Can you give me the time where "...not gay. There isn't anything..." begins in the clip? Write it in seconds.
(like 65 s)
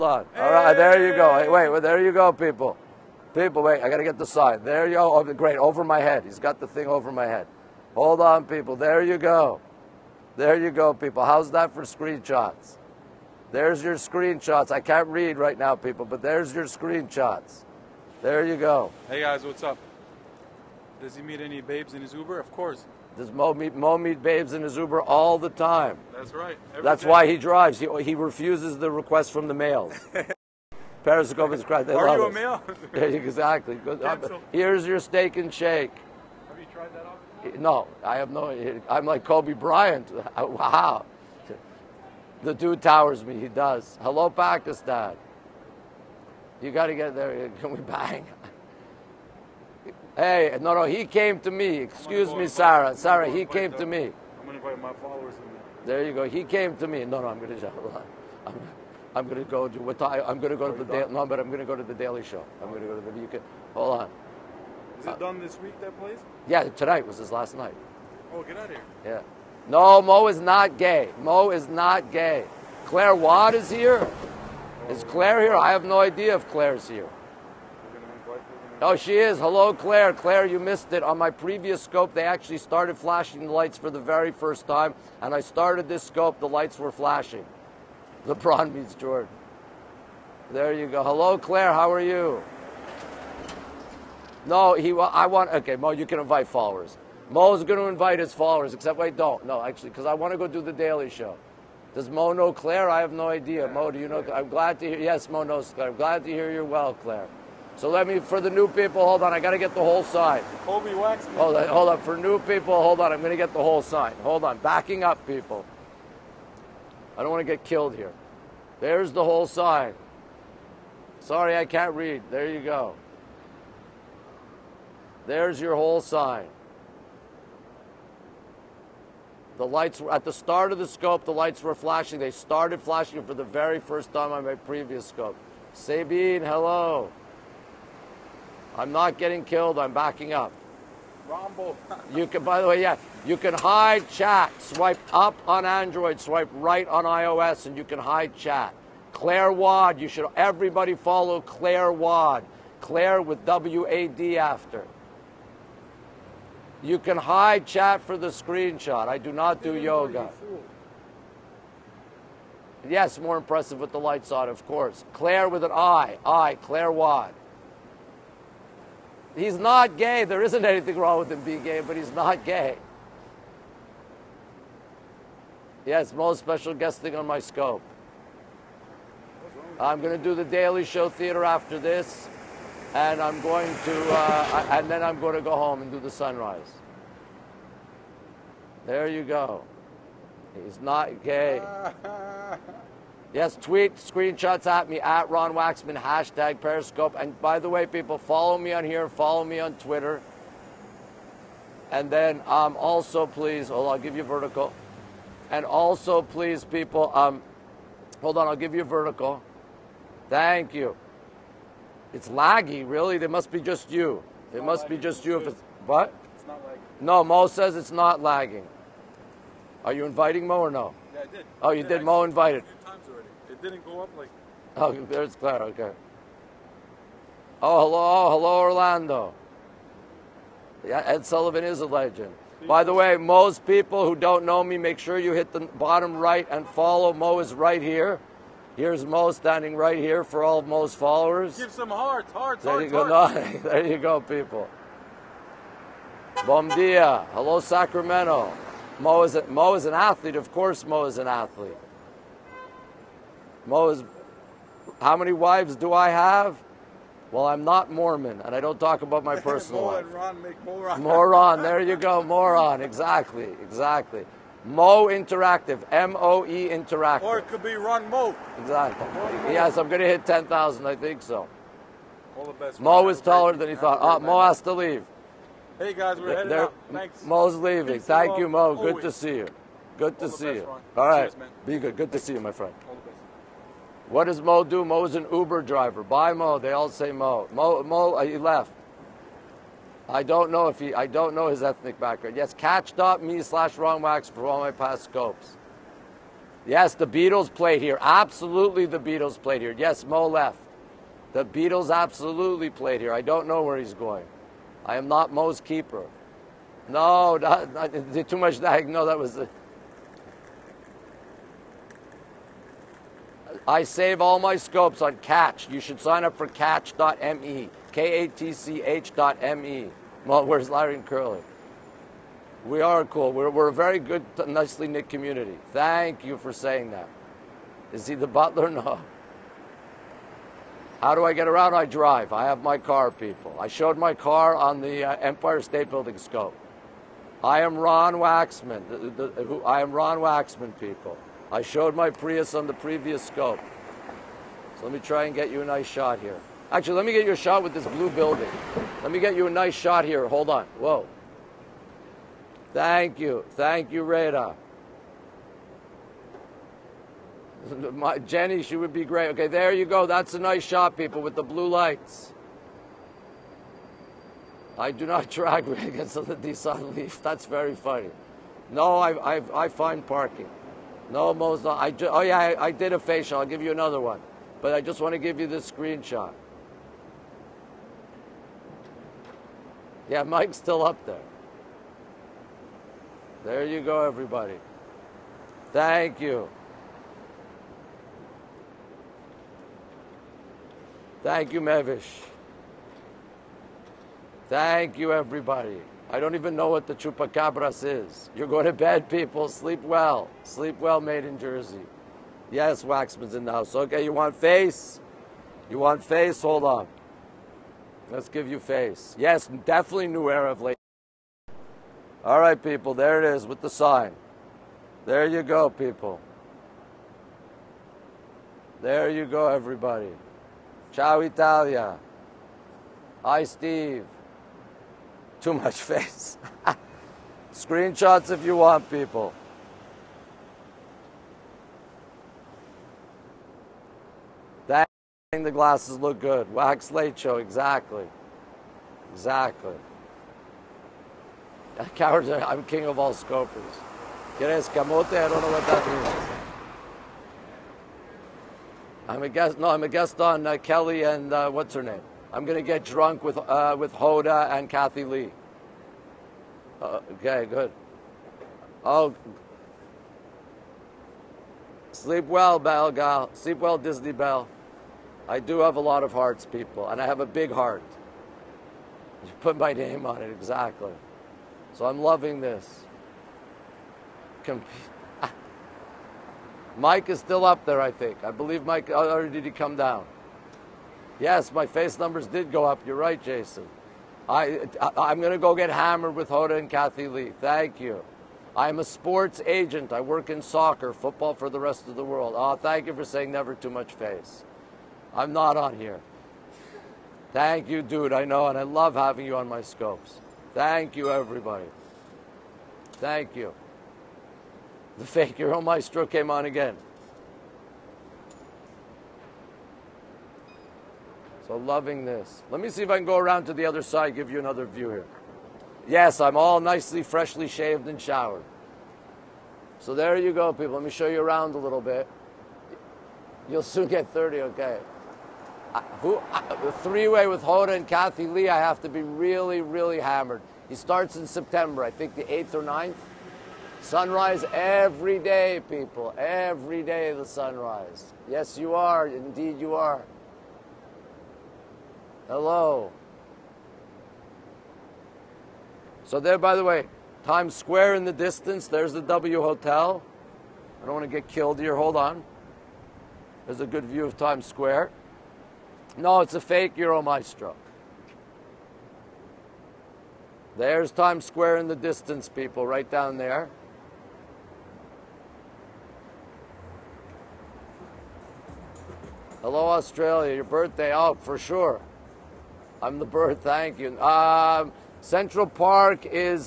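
169 s.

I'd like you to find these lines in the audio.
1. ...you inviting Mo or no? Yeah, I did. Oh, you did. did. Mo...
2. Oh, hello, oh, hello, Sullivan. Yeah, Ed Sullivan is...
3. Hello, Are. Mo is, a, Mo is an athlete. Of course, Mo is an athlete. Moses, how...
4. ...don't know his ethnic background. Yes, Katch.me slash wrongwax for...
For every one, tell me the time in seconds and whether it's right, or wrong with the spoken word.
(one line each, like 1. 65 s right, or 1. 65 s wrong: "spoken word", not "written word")
1. 219 s right
2. 227 s wrong: "Orlando", not "Sullivan"
3. 247 s wrong: "Sacramento", not "Are"
4. 291 s right.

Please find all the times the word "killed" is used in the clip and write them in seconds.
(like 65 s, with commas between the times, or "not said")
117 s, 139 s, 551 s.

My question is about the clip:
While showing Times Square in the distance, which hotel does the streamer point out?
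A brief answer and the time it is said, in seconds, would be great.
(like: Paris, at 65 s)
W Hotel, at 548 s.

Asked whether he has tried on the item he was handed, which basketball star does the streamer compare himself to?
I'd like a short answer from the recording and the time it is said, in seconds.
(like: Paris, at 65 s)
Kobe Bryant, at 39 s.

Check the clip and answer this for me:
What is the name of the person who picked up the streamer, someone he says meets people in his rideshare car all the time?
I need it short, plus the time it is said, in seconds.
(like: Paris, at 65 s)
Moamid, at 23 s.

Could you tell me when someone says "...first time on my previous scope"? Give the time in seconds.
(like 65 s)
133 s.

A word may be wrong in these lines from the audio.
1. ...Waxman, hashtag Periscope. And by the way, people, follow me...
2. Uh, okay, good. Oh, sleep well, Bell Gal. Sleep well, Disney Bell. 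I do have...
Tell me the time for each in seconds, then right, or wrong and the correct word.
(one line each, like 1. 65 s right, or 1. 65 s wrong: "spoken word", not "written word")
1. 195 s right
2. 456 s right.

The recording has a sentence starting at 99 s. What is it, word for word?
No, actually, because I want to go do the Daily Show.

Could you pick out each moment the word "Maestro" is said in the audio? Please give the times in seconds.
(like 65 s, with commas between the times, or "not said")
505 s, 557 s.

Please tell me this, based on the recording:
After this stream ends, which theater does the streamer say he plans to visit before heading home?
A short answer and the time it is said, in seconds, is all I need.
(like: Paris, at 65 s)
Daily Show Theater, at 180 s.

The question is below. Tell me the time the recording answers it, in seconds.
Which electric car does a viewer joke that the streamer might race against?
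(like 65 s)
366 s.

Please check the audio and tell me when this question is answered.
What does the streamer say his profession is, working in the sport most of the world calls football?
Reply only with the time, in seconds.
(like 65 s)
488 s.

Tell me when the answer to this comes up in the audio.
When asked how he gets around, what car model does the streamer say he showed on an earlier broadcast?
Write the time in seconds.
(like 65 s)
341 s.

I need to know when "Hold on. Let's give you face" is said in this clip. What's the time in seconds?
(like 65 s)
406 s.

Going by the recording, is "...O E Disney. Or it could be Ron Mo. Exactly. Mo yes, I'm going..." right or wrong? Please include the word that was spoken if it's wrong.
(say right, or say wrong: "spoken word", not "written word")
wrong: "Interactive", not "Disney".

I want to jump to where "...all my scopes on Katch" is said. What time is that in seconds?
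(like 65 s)
314 s.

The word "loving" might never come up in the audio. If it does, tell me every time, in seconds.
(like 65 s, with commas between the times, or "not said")
472 s, 511 s.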